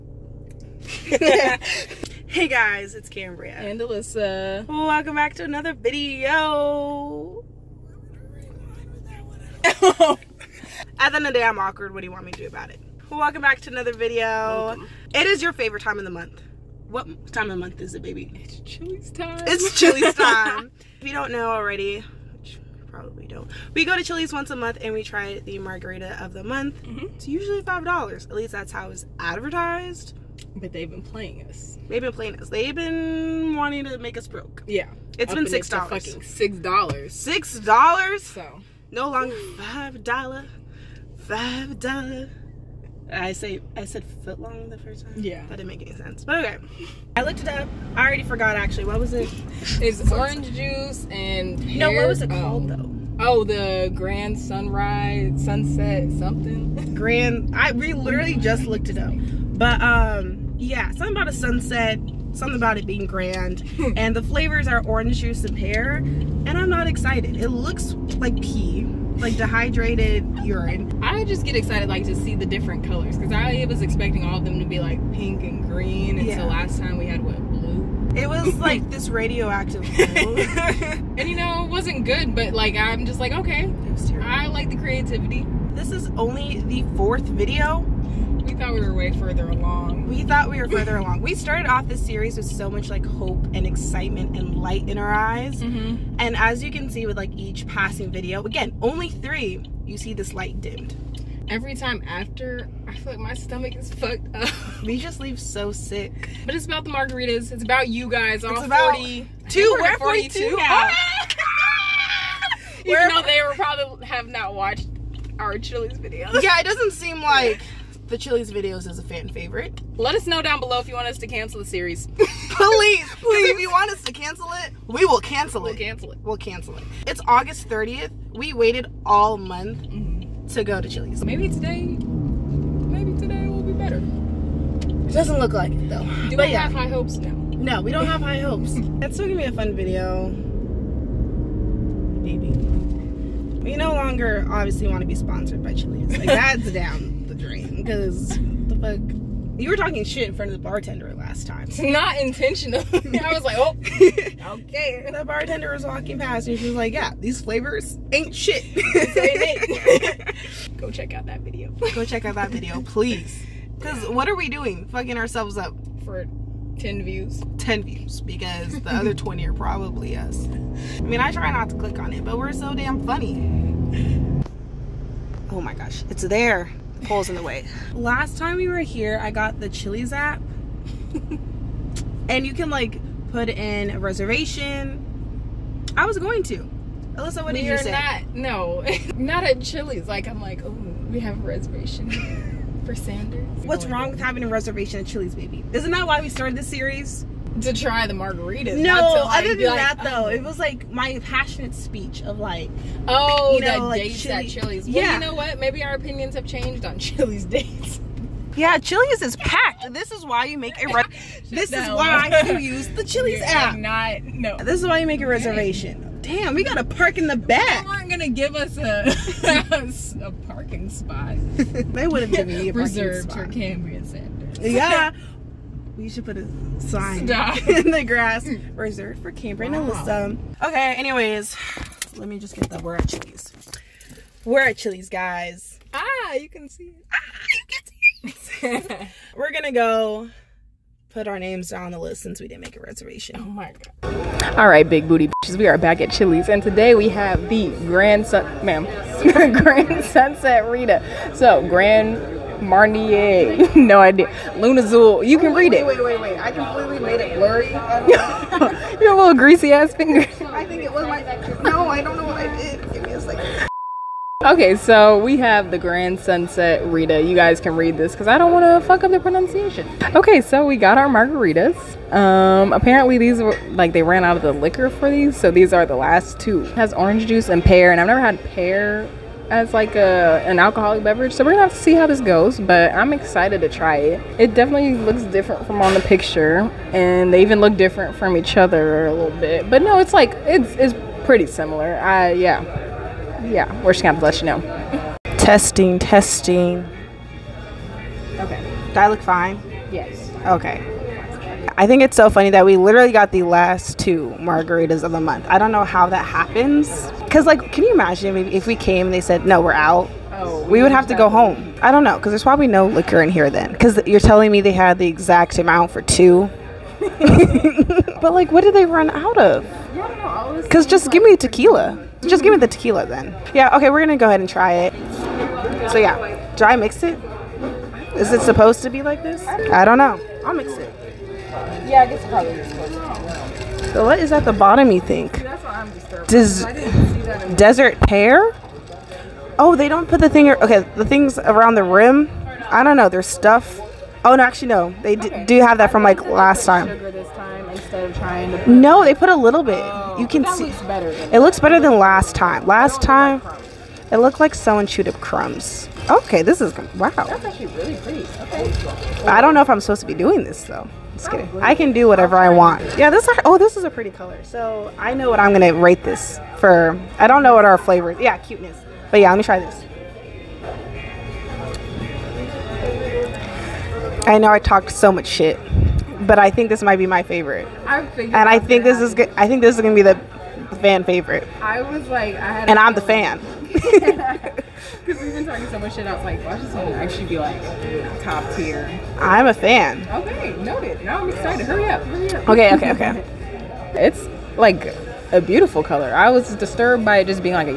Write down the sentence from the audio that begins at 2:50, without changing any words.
I mean, I try not to click on it, but we're so damn funny.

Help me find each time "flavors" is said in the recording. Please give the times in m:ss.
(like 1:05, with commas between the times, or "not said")
1:04, 2:37, 6:07.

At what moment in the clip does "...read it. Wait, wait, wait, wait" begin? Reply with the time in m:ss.
4:15.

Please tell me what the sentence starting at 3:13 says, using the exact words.
What's wrong with having a reservation at Chili's, baby?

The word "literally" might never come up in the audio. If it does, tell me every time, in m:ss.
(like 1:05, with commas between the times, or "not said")
0:57, 5:02.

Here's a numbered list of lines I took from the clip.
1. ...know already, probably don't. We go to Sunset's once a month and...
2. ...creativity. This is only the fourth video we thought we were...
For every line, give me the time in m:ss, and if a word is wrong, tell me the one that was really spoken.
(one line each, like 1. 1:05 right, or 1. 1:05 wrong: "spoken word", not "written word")
1. 0:21 wrong: "Chili", not "Sunset"
2. 1:24 right.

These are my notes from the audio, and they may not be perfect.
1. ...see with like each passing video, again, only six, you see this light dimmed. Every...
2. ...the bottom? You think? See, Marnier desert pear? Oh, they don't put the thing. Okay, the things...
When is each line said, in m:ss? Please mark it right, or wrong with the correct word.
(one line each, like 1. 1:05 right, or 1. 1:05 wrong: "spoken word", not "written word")
1. 1:36 wrong: "three", not "six"
2. 5:34 wrong: "Does", not "Marnier".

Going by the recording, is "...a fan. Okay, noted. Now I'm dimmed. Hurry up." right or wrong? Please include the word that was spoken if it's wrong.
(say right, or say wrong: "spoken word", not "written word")
wrong: "excited", not "dimmed".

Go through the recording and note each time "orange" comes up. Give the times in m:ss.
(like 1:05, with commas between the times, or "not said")
0:50, 1:04, 4:36.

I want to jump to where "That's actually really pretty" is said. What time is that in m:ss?
5:57.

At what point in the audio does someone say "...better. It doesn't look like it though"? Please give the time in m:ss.
2:13.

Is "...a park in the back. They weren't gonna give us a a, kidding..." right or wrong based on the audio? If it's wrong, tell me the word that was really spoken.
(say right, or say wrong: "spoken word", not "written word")
wrong: "parking", not "kidding".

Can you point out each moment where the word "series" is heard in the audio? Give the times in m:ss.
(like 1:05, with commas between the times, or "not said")
1:31, 2:01, 3:16.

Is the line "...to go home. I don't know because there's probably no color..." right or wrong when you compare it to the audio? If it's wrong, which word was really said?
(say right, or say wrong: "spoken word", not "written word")
wrong: "liquor", not "color".